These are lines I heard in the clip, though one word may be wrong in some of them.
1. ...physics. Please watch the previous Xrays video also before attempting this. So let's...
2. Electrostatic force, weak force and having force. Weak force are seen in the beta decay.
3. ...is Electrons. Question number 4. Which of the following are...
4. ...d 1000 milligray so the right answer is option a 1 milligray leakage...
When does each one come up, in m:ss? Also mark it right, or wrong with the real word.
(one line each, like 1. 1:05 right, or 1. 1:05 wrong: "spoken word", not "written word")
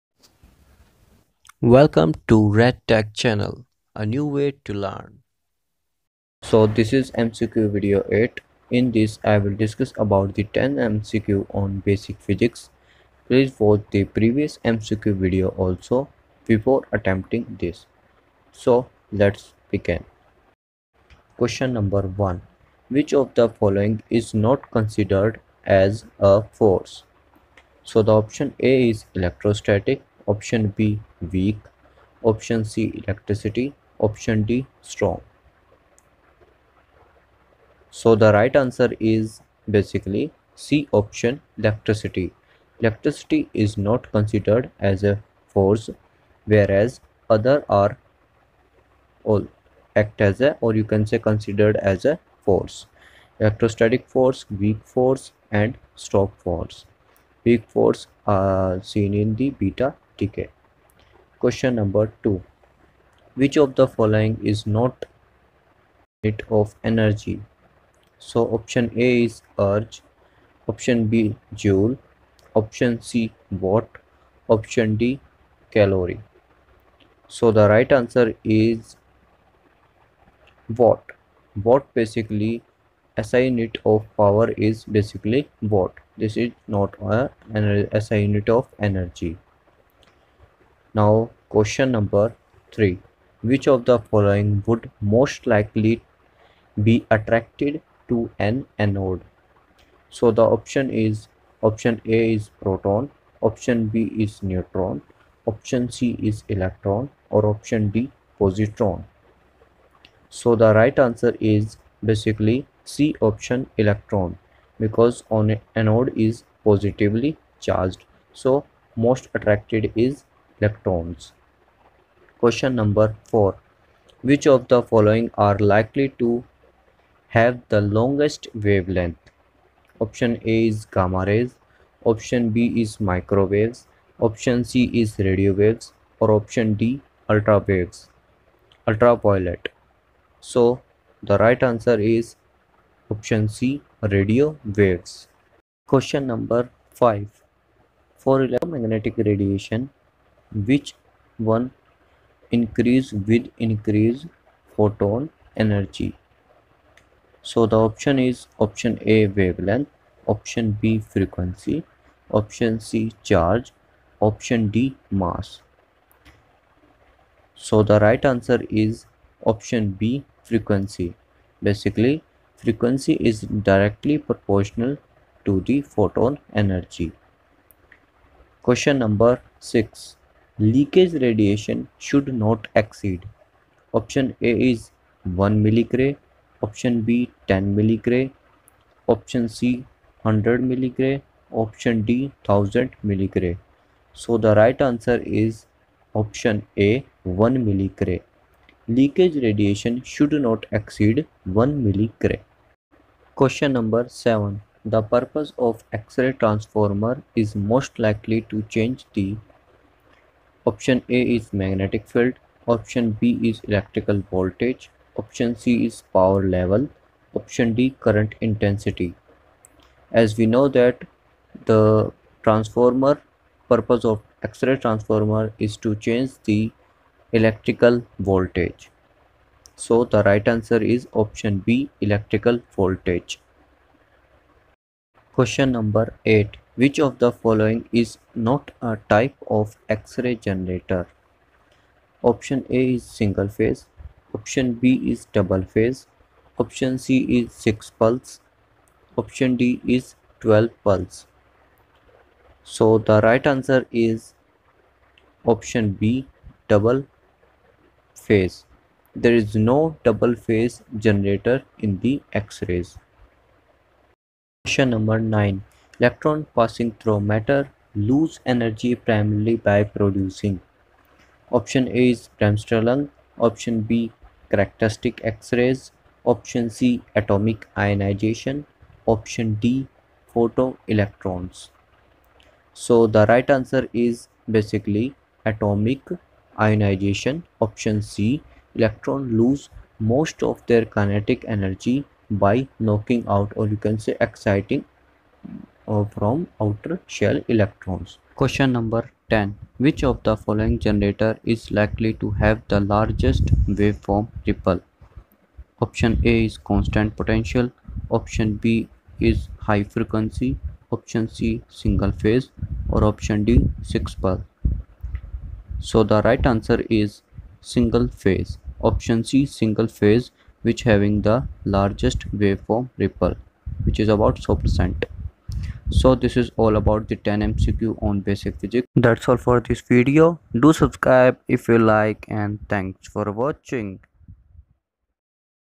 1. 0:12 wrong: "MCQ", not "Xrays"
2. 0:53 wrong: "strong", not "having"
3. 1:59 right
4. 3:12 right.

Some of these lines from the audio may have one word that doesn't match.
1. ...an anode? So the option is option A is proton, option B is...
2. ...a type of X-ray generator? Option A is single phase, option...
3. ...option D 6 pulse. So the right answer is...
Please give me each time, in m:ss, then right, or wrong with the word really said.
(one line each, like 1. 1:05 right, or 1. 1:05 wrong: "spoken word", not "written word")
1. 1:38 right
2. 3:58 right
3. 5:13 right.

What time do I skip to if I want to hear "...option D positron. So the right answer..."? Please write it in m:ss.
1:47.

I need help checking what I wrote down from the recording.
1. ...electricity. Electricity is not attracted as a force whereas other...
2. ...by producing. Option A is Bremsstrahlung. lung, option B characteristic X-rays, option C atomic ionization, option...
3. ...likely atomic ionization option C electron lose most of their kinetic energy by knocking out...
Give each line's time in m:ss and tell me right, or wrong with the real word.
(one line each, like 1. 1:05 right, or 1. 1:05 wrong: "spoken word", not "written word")
1. 0:41 wrong: "considered", not "attracted"
2. 4:29 right
3. 4:44 wrong: "basically", not "likely".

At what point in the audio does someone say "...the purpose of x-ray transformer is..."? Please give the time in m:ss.
3:24.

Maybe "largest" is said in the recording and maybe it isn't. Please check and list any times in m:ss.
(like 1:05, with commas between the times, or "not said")
5:02, 5:21.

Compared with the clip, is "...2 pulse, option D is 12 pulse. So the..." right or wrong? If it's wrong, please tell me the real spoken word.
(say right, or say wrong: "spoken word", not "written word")
wrong: "6", not "2".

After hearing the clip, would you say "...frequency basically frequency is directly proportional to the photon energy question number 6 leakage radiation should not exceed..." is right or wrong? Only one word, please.
right.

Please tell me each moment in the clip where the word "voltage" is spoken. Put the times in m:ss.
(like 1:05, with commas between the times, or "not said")
3:34, 3:48, 3:52.